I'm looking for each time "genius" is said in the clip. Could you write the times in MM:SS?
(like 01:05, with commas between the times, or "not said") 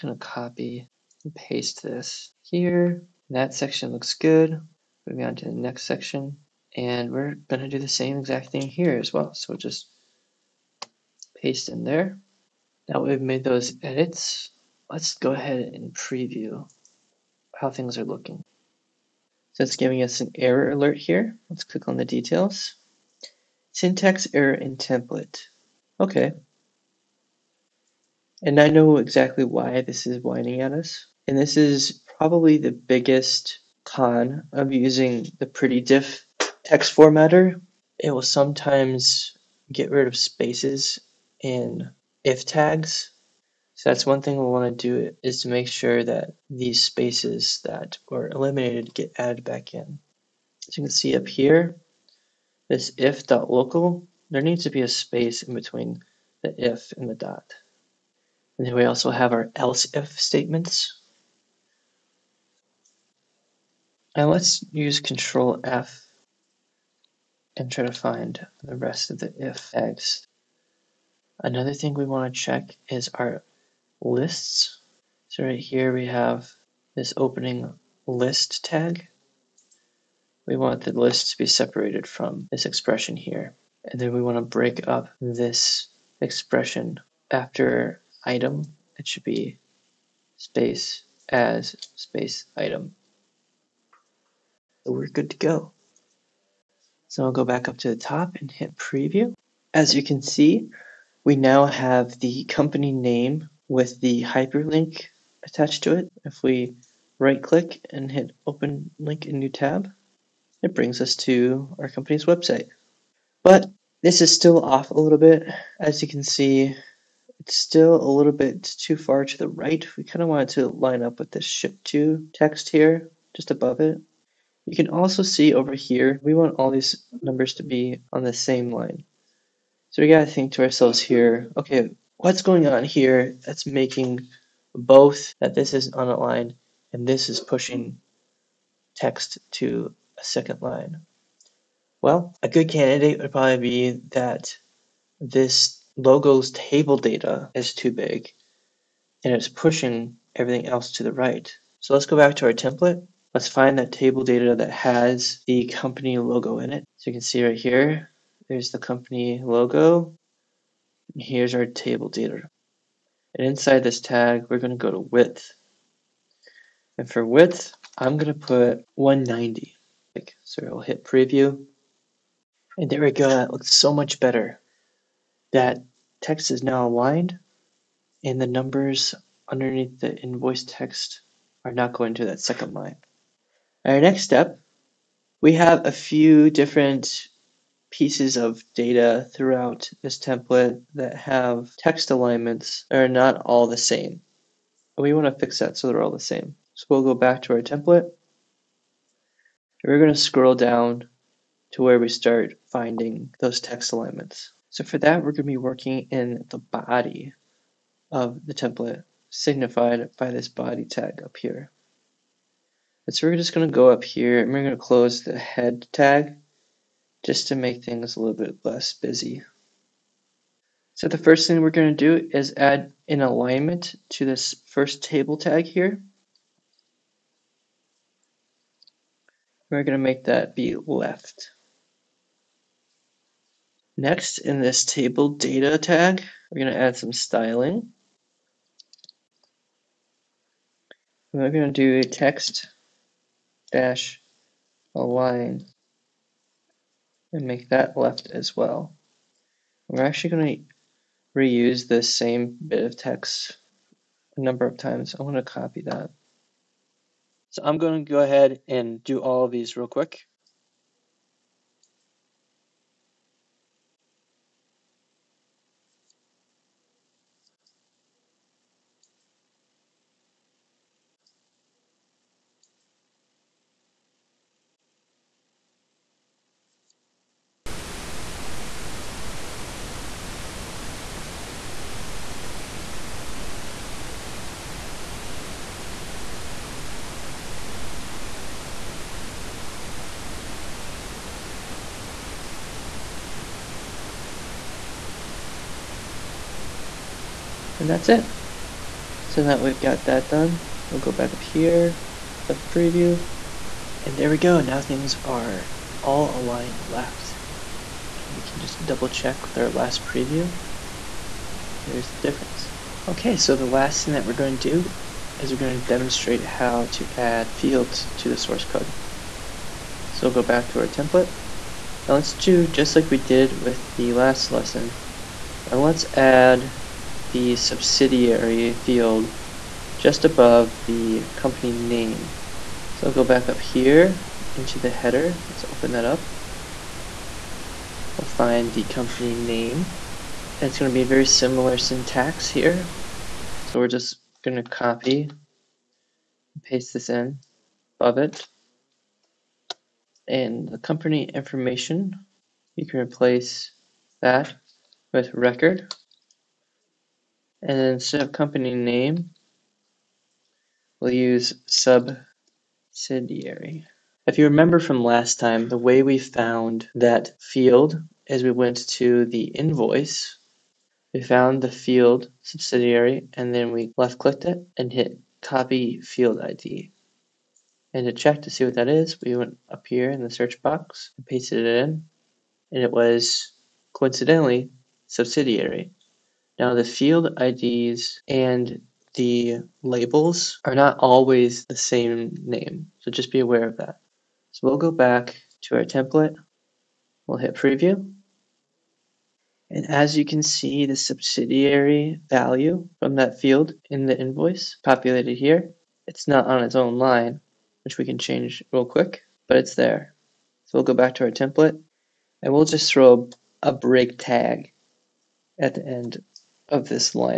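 not said.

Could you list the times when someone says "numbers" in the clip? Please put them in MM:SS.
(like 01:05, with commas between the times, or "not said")
02:07, 02:58, 04:14.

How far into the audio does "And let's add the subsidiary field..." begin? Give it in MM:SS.
05:25.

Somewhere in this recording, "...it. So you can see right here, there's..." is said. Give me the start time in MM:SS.
02:36.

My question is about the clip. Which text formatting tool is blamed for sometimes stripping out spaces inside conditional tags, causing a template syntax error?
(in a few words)
pretty diff.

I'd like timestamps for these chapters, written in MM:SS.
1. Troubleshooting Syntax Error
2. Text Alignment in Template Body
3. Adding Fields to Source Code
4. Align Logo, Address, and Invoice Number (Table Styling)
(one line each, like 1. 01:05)
1. 00:12
2. 03:03
3. 05:12
4. 01:36.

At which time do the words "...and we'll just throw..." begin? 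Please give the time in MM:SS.
06:52.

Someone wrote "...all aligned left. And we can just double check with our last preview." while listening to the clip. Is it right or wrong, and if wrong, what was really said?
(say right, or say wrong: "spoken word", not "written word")
right.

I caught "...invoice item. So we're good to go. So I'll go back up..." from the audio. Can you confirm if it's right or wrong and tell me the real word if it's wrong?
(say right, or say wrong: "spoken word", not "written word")
wrong: "space", not "invoice".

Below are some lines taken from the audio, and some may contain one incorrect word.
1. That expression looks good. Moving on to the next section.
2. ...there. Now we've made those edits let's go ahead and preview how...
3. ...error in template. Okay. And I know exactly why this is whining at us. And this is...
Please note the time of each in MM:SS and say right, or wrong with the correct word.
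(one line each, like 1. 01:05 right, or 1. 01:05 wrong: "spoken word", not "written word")
1. 00:03 wrong: "section", not "expression"
2. 00:11 right
3. 00:24 right.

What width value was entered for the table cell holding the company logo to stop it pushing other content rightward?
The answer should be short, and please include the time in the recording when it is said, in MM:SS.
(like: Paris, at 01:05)
190, at 02:48.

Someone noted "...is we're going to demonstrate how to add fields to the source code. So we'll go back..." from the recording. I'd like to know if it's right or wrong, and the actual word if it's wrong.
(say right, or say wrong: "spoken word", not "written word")
right.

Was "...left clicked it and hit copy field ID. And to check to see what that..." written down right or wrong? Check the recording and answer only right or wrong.
right.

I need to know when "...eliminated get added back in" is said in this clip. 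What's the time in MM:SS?
00:48.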